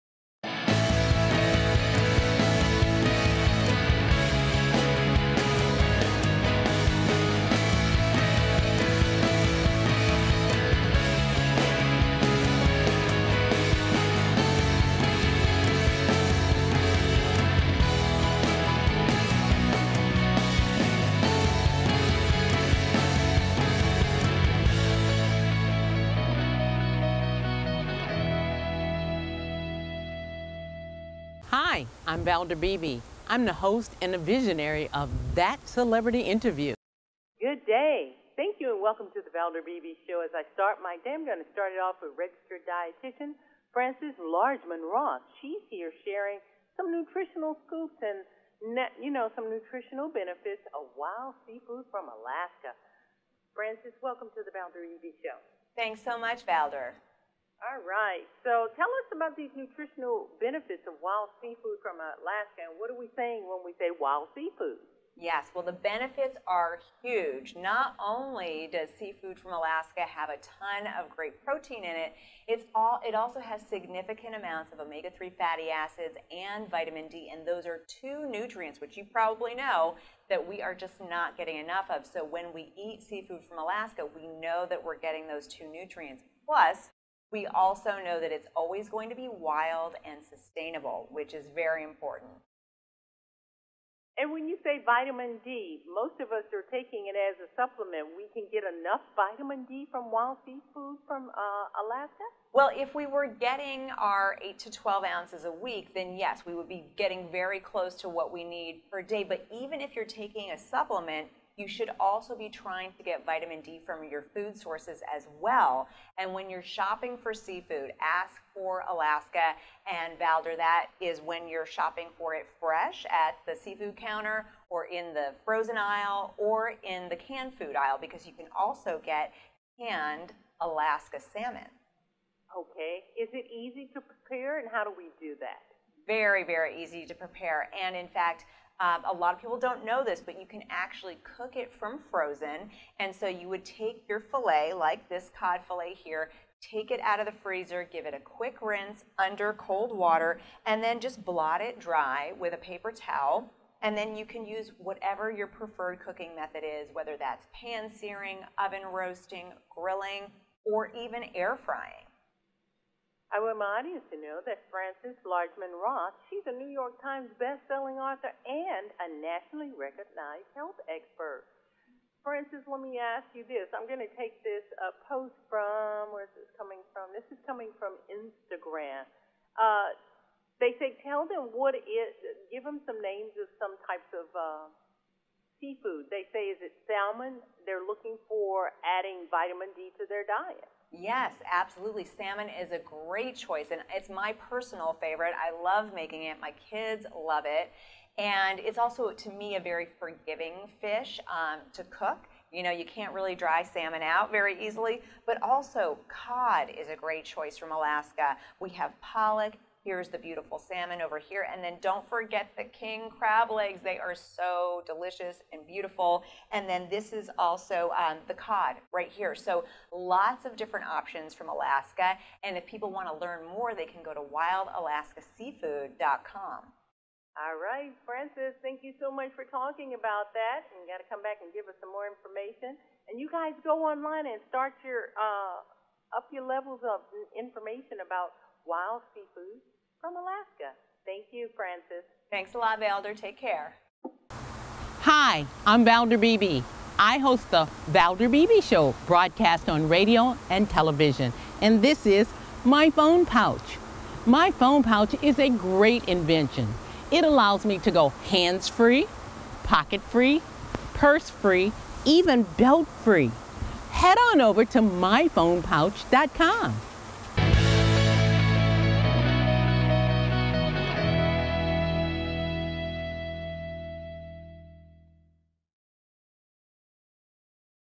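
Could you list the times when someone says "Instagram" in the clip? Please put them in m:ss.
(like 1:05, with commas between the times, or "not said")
2:58.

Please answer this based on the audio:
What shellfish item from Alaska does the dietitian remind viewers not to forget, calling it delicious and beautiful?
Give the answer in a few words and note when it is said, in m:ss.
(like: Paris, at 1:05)
King crab legs, at 3:32.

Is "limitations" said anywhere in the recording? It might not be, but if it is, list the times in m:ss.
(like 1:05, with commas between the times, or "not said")
not said.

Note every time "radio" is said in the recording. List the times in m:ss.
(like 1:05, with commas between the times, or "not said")
4:09.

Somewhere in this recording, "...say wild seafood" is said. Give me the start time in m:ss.
1:03.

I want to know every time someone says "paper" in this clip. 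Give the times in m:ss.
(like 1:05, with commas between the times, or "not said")
2:32.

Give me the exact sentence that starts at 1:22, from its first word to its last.
So when we eat seafood from Alaska, we know that we're getting those two nutrients.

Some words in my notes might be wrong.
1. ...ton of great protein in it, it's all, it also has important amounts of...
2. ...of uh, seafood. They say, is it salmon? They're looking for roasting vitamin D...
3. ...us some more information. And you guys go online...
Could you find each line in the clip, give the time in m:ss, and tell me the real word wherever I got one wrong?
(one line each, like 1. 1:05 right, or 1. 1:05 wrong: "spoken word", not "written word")
1. 1:10 wrong: "significant", not "important"
2. 3:04 wrong: "adding", not "roasting"
3. 3:51 right.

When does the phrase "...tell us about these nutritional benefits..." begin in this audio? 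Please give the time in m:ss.
0:58.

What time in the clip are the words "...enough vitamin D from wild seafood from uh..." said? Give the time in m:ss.
1:38.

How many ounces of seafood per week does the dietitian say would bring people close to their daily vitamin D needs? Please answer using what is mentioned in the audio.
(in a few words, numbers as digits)
8 to 12.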